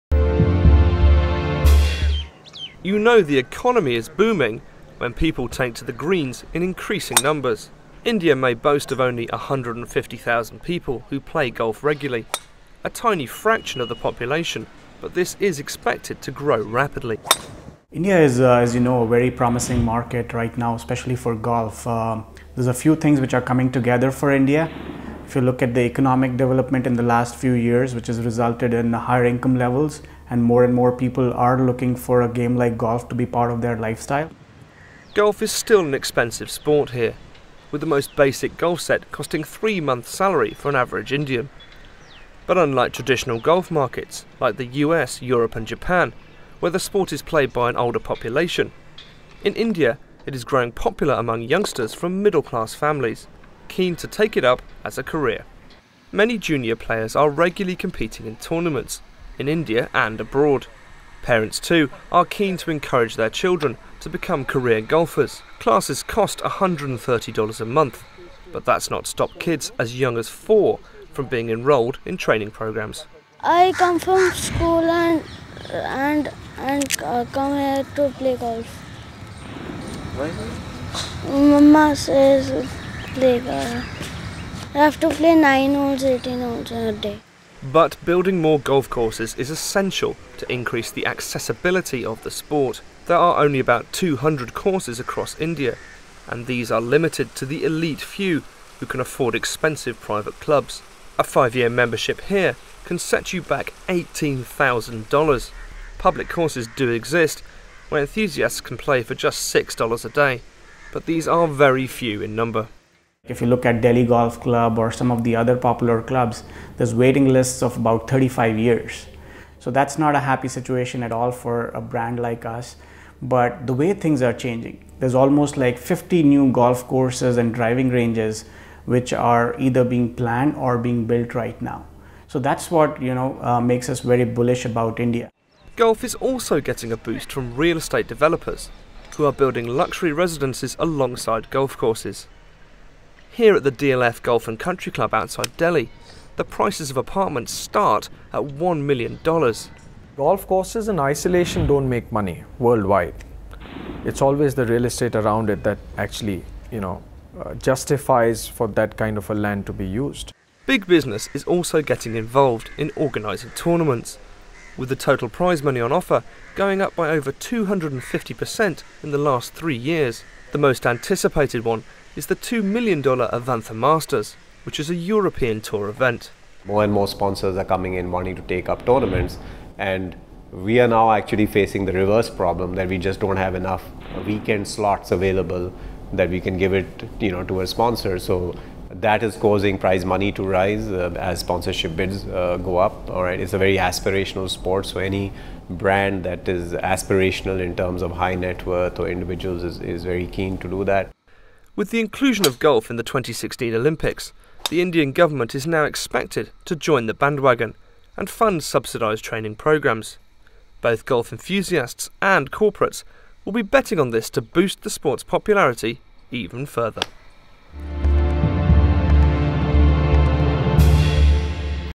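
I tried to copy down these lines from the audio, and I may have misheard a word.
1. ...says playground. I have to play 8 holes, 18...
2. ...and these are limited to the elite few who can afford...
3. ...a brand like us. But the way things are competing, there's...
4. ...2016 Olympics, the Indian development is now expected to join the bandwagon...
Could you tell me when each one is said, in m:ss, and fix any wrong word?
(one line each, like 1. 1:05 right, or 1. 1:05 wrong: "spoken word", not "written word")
1. 1:21 wrong: "9", not "8"
2. 1:36 right
3. 2:01 wrong: "changing", not "competing"
4. 3:23 wrong: "government", not "development".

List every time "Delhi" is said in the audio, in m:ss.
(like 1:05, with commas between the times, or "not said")
1:53, 2:25.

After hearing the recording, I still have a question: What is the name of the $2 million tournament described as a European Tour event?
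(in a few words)
Avantha Masters.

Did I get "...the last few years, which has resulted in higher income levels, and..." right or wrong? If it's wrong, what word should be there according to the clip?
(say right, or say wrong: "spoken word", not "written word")
right.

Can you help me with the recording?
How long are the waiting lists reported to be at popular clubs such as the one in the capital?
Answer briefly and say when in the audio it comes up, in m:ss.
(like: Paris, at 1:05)
35 years, at 1:58.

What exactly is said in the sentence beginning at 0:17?
India is, uh, as you know, a very promising market right now, especially for golf.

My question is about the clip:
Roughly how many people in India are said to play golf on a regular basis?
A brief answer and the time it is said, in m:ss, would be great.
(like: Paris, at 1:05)
150,000, at 0:09.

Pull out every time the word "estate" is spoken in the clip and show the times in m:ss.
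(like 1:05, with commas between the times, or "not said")
2:17, 2:34.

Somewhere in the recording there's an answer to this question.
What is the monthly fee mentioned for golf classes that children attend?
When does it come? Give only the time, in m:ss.
1:06.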